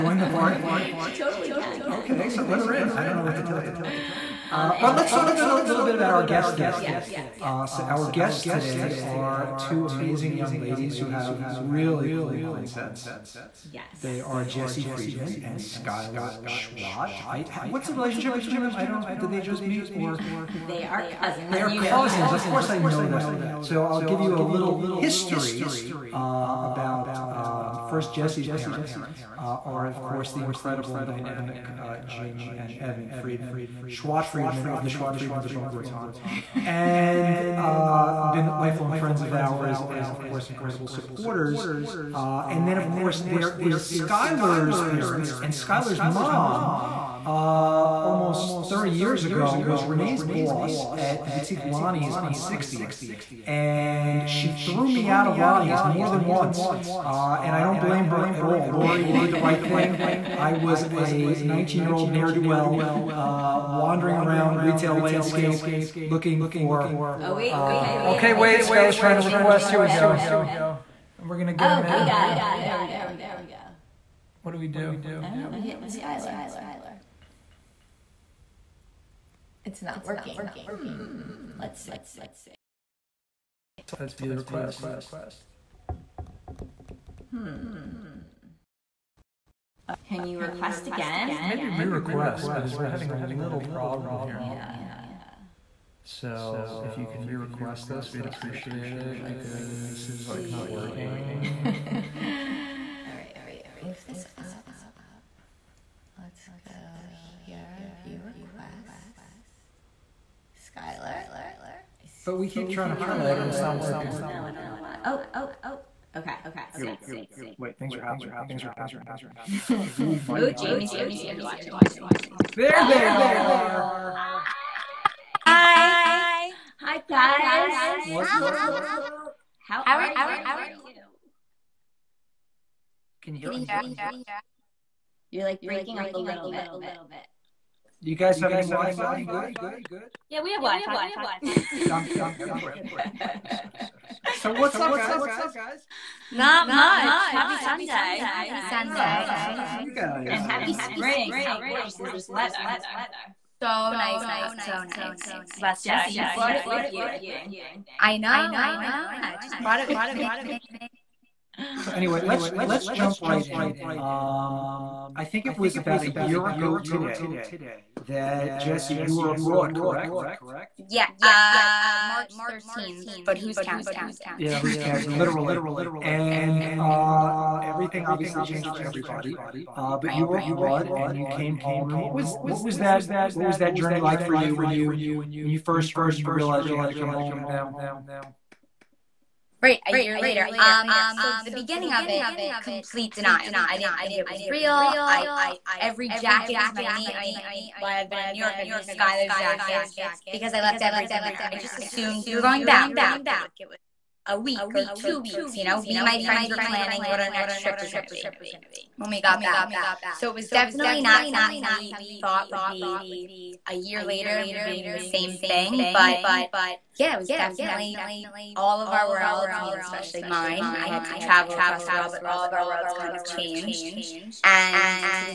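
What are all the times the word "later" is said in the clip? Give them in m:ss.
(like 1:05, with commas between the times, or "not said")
3:10, 3:34.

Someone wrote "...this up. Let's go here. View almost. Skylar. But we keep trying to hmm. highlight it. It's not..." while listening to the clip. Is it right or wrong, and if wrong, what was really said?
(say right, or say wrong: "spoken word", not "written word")
wrong: "request", not "almost".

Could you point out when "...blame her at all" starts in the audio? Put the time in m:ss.
0:57.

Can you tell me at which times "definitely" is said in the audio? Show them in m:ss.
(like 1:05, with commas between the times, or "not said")
3:30, 3:37.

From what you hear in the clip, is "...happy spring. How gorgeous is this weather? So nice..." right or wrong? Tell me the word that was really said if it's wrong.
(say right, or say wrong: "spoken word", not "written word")
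right.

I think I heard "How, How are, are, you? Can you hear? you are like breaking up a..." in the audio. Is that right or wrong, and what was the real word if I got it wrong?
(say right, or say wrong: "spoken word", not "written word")
right.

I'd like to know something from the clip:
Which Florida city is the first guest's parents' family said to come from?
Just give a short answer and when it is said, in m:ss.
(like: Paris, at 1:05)
Boca Raton, at 0:35.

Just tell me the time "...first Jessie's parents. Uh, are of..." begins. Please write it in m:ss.
0:27.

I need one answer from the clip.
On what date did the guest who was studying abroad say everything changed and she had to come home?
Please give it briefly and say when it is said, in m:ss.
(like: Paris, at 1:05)
March 13, at 2:51.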